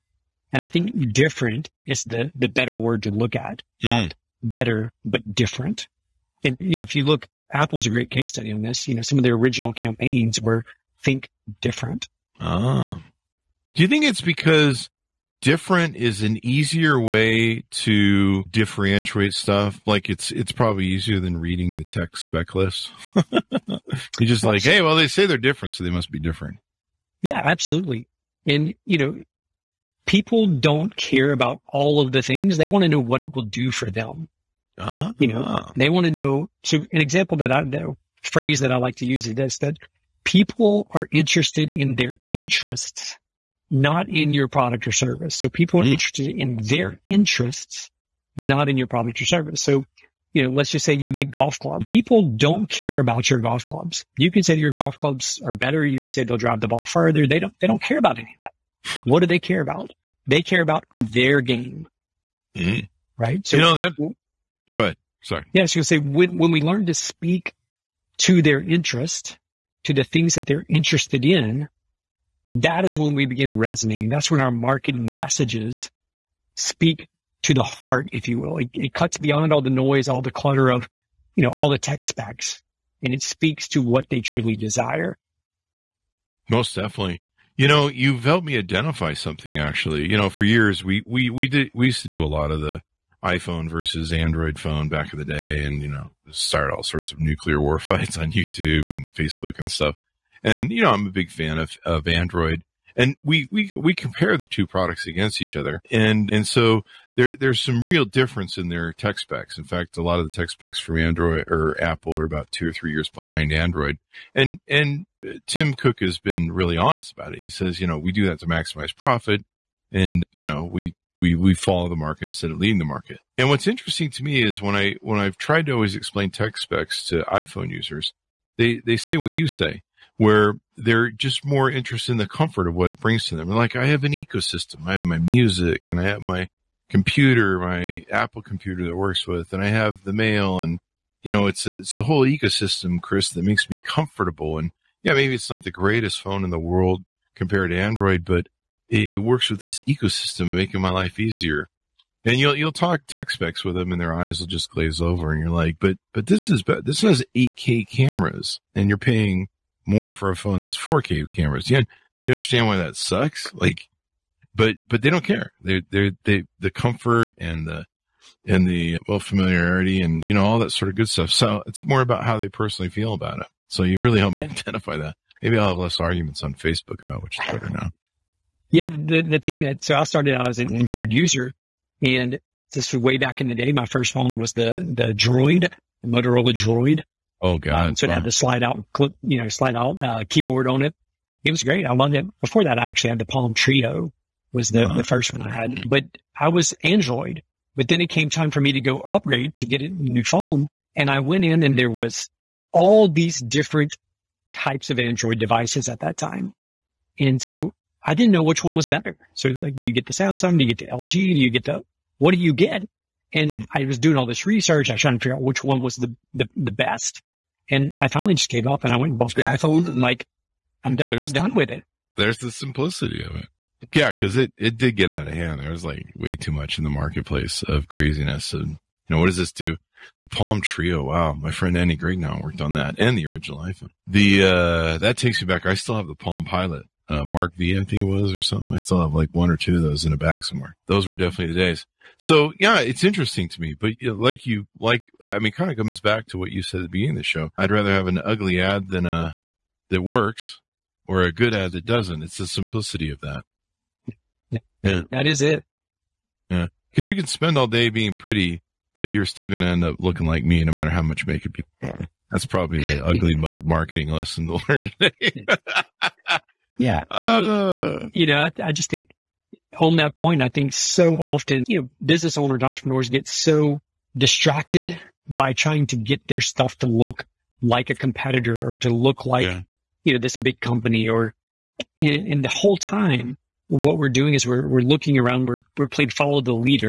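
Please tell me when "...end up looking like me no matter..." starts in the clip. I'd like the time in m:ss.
4:19.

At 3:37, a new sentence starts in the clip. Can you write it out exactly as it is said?
And I finally just gave up and I went and bought the iPhone and like, I'm done, I'm done with it.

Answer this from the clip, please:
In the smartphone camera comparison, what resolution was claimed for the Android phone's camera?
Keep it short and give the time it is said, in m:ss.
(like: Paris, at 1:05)
8K, at 2:37.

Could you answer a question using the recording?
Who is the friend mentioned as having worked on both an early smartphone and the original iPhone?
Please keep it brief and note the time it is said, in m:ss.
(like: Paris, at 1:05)
Andy Grignon, at 3:51.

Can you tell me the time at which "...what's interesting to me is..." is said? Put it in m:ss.
2:03.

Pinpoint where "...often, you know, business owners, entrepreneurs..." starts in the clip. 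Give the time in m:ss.
4:31.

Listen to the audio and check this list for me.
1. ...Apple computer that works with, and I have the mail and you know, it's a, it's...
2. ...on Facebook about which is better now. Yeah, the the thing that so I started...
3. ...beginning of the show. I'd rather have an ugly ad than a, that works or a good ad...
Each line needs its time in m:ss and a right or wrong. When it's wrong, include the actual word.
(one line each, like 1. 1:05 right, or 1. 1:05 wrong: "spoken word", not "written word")
1. 2:18 right
2. 2:56 right
3. 4:06 right.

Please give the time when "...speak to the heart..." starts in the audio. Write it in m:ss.
1:16.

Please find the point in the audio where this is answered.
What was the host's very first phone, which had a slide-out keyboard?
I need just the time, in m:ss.
3:06.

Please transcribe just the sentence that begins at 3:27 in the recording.
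And so I didn't know which one was better.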